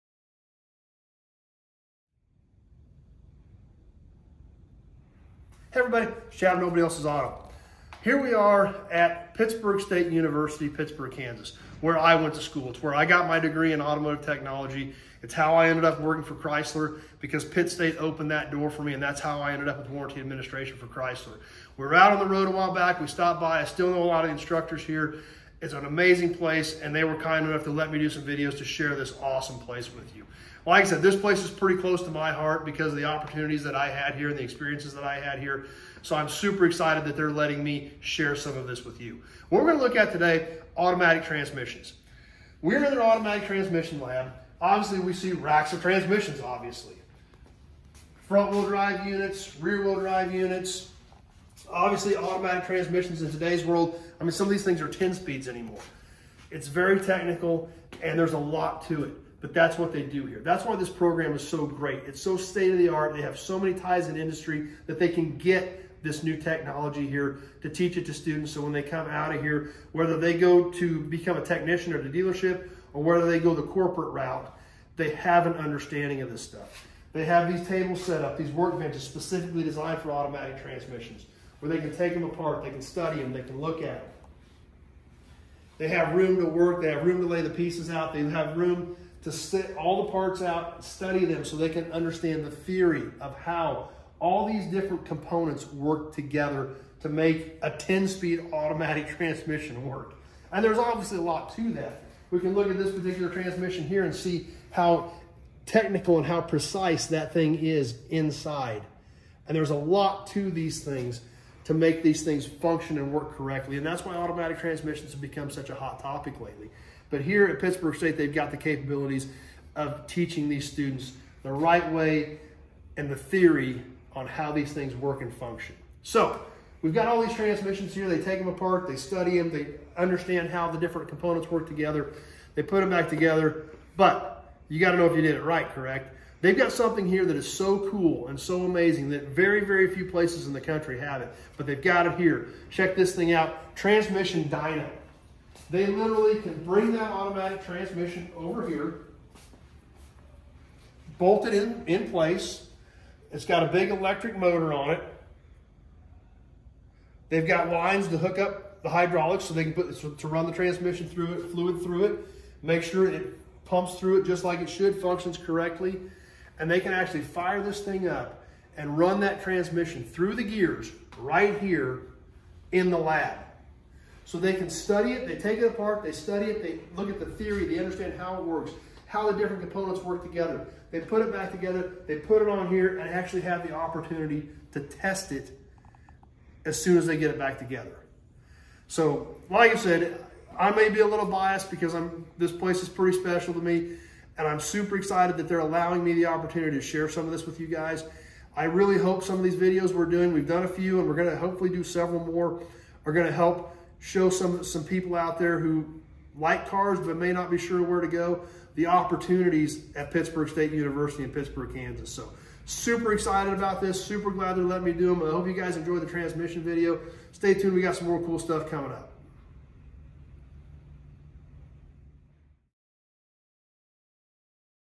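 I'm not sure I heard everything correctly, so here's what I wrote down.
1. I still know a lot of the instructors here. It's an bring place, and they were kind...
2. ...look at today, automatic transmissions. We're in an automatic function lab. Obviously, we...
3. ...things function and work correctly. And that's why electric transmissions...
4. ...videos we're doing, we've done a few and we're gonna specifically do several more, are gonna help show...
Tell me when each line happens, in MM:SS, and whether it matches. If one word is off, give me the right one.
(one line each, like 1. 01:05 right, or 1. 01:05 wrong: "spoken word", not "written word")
1. 00:23 wrong: "amazing", not "bring"
2. 00:39 wrong: "transmission", not "function"
3. 01:52 wrong: "automatic", not "electric"
4. 03:19 wrong: "hopefully", not "specifically".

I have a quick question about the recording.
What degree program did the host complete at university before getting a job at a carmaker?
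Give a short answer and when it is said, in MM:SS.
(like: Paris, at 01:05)
automotive technology, at 00:13.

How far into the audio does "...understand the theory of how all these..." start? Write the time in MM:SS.
01:31.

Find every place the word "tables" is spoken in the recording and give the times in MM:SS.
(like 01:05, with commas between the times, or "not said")
01:17.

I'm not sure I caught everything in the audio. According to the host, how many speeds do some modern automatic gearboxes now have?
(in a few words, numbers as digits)
10.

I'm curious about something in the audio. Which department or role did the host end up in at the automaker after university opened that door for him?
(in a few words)
warranty administration.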